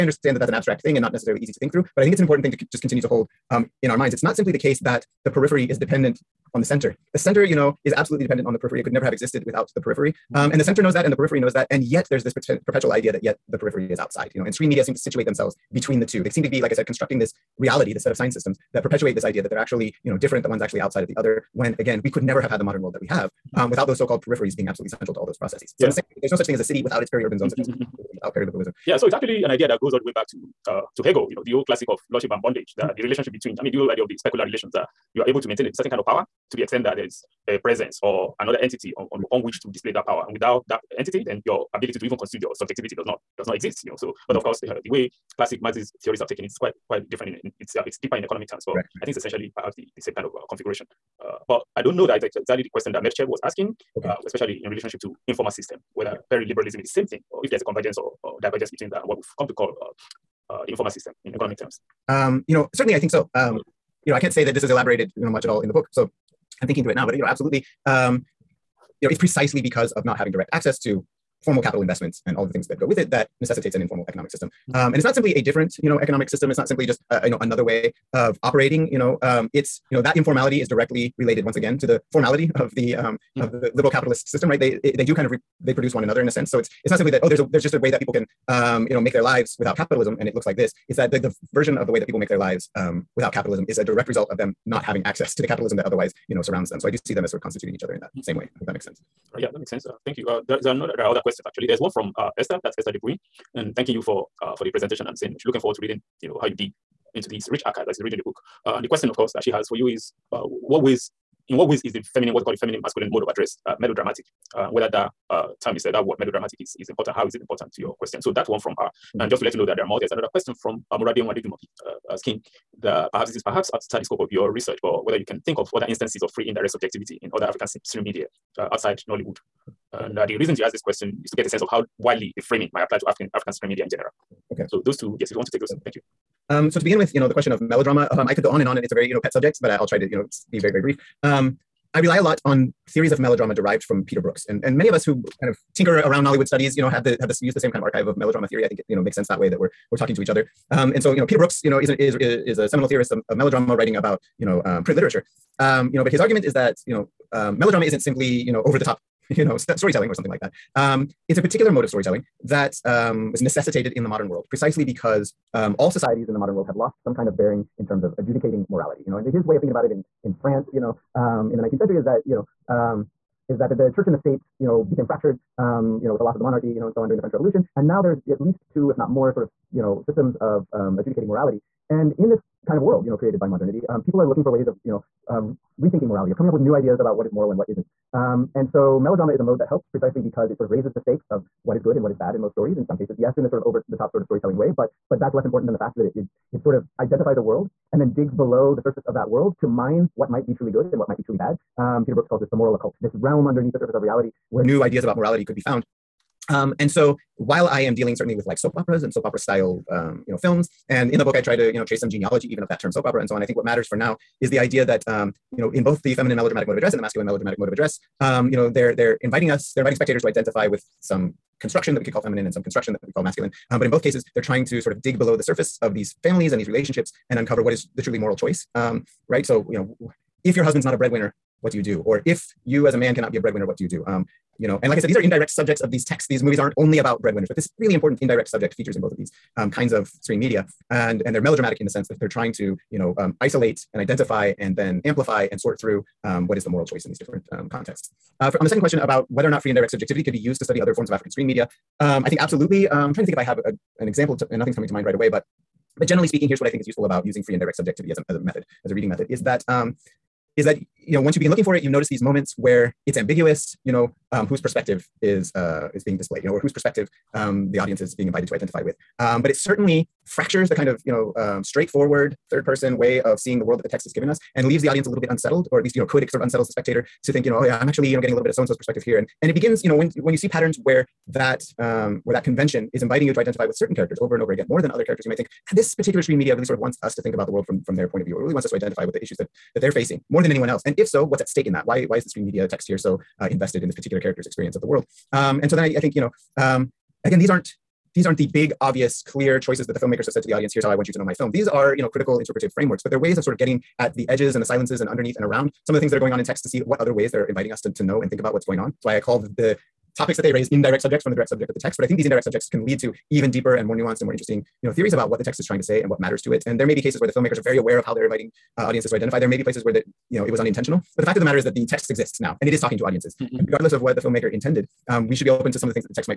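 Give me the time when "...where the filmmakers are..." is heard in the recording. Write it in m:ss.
5:17.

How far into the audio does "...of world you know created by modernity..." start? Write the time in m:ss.
3:02.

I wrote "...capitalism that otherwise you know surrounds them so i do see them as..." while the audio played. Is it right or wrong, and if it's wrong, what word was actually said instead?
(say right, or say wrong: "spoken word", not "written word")
right.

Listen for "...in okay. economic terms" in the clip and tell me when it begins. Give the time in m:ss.
1:01.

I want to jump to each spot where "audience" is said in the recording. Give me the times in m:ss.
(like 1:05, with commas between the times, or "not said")
4:27, 4:34, 5:00, 5:18, 5:23.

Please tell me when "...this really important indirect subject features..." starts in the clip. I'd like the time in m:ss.
3:57.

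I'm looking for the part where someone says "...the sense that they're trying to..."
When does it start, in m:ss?
4:01.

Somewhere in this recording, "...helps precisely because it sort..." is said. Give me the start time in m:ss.
3:09.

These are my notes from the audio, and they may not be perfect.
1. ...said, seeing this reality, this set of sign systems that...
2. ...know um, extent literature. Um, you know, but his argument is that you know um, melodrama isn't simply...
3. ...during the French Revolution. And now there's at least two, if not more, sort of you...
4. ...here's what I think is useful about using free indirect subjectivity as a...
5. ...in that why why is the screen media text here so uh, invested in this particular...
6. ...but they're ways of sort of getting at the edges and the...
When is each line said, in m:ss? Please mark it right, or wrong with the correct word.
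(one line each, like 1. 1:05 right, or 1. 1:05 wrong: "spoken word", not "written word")
1. 0:16 wrong: "constructing", not "seeing"
2. 2:34 wrong: "print", not "extent"
3. 2:57 right
4. 4:16 right
5. 4:51 right
6. 5:03 right.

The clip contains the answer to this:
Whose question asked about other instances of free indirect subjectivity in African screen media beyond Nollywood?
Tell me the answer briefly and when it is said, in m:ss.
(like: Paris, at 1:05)
Moradewun Adejunmobi, at 2:00.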